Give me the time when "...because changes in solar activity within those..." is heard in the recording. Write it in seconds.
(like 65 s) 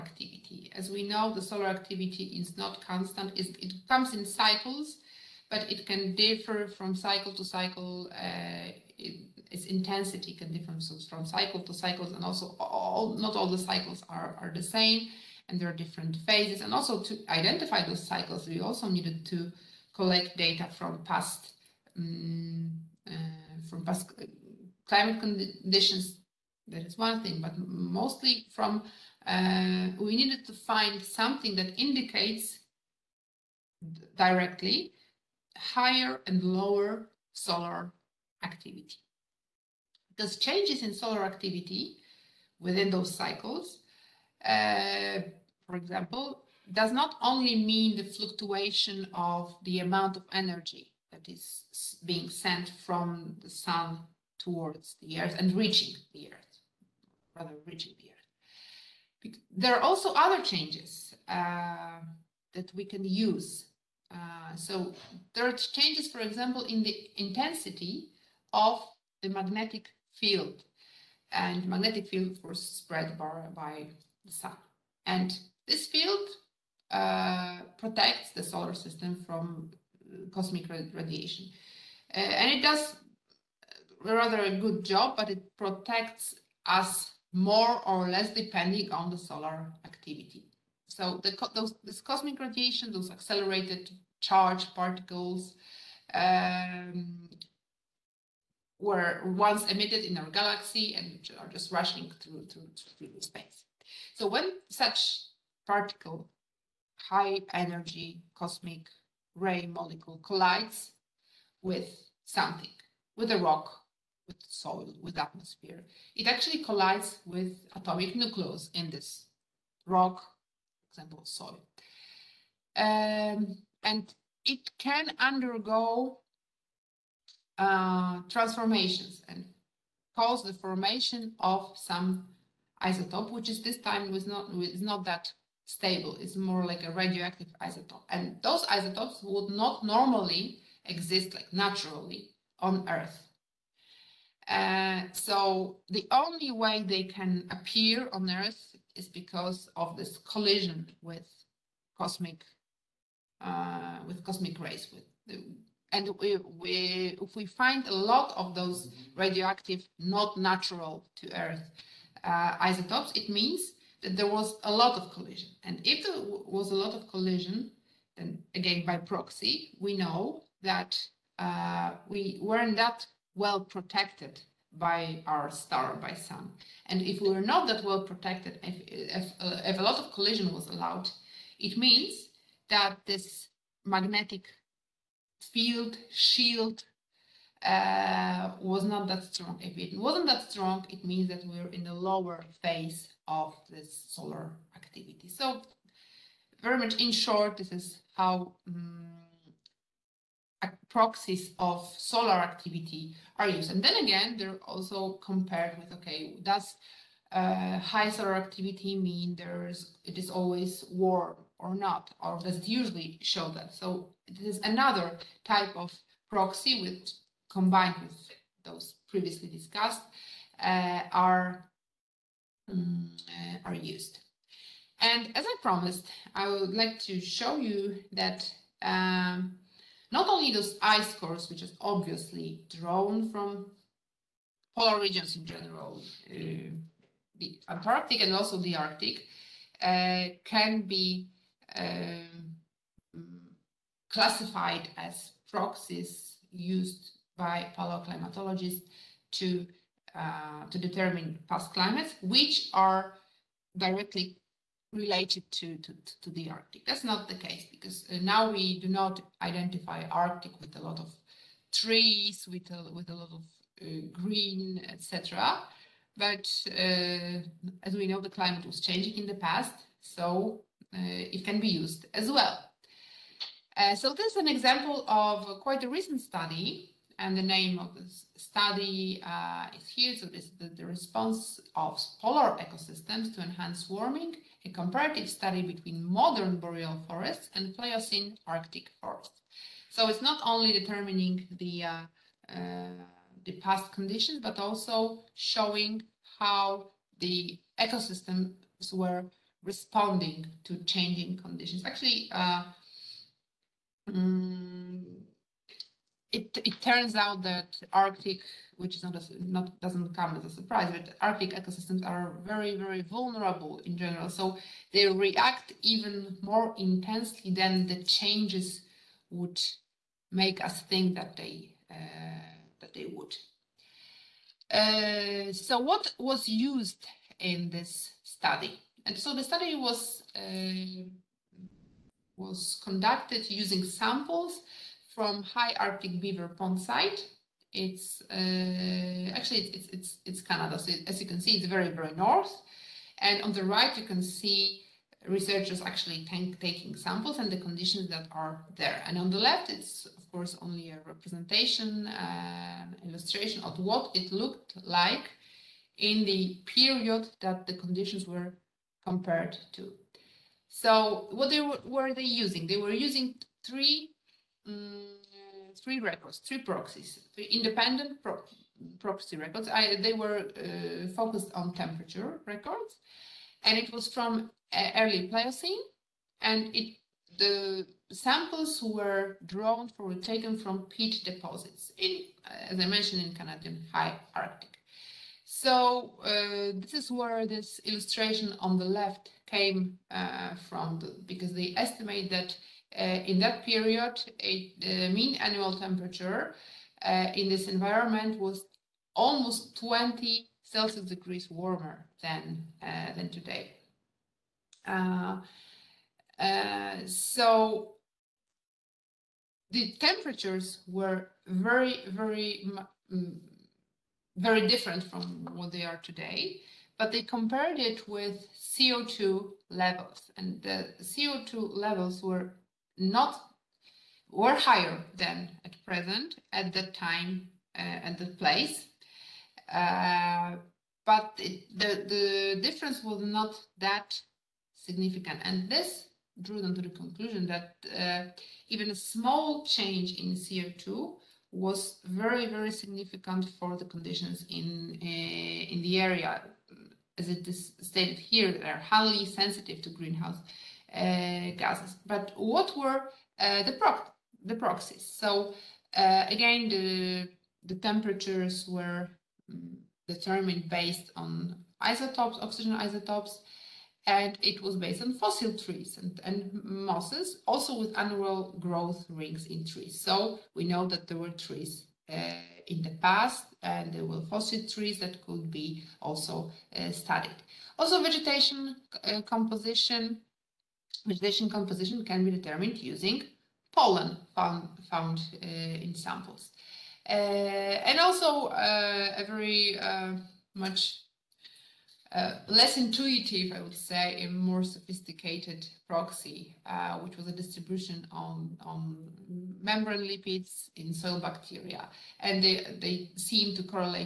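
40 s.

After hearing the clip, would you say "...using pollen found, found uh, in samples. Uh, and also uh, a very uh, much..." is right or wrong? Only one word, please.
right.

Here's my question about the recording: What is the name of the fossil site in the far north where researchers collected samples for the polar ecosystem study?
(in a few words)
High Arctic Beaver Pond.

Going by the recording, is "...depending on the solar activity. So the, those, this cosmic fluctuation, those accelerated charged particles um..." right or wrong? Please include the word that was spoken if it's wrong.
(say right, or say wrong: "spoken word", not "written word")
wrong: "radiation", not "fluctuation".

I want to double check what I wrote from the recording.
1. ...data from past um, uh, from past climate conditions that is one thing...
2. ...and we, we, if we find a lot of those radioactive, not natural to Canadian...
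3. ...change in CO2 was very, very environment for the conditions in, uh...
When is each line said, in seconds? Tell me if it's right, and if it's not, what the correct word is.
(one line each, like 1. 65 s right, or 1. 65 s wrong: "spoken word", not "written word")
1. 20 s right
2. 155 s wrong: "Earth", not "Canadian"
3. 439 s wrong: "significant", not "environment".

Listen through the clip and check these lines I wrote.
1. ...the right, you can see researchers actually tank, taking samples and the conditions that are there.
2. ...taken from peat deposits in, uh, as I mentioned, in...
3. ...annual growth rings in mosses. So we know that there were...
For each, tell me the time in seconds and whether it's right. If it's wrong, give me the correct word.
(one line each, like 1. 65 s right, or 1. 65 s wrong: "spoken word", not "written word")
1. 343 s right
2. 380 s right
3. 467 s wrong: "trees", not "mosses".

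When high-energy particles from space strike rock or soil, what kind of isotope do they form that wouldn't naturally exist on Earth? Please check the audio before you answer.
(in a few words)
radioactive isotope.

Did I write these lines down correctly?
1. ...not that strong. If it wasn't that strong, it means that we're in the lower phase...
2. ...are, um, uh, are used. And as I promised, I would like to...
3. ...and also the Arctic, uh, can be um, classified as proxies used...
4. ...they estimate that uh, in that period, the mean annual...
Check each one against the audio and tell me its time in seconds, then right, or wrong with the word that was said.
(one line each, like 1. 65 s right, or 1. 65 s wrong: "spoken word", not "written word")
1. 188 s right
2. 221 s right
3. 238 s right
4. 391 s right.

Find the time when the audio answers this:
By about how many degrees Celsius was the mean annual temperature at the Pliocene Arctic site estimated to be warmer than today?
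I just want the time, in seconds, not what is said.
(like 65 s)
399 s.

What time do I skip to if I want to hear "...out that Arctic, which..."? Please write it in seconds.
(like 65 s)
307 s.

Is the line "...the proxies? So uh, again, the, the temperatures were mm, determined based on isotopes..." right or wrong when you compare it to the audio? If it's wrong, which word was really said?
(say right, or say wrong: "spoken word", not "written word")
right.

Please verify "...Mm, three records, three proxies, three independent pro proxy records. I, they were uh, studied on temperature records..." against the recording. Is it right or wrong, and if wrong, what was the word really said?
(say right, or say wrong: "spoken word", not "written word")
wrong: "focused", not "studied".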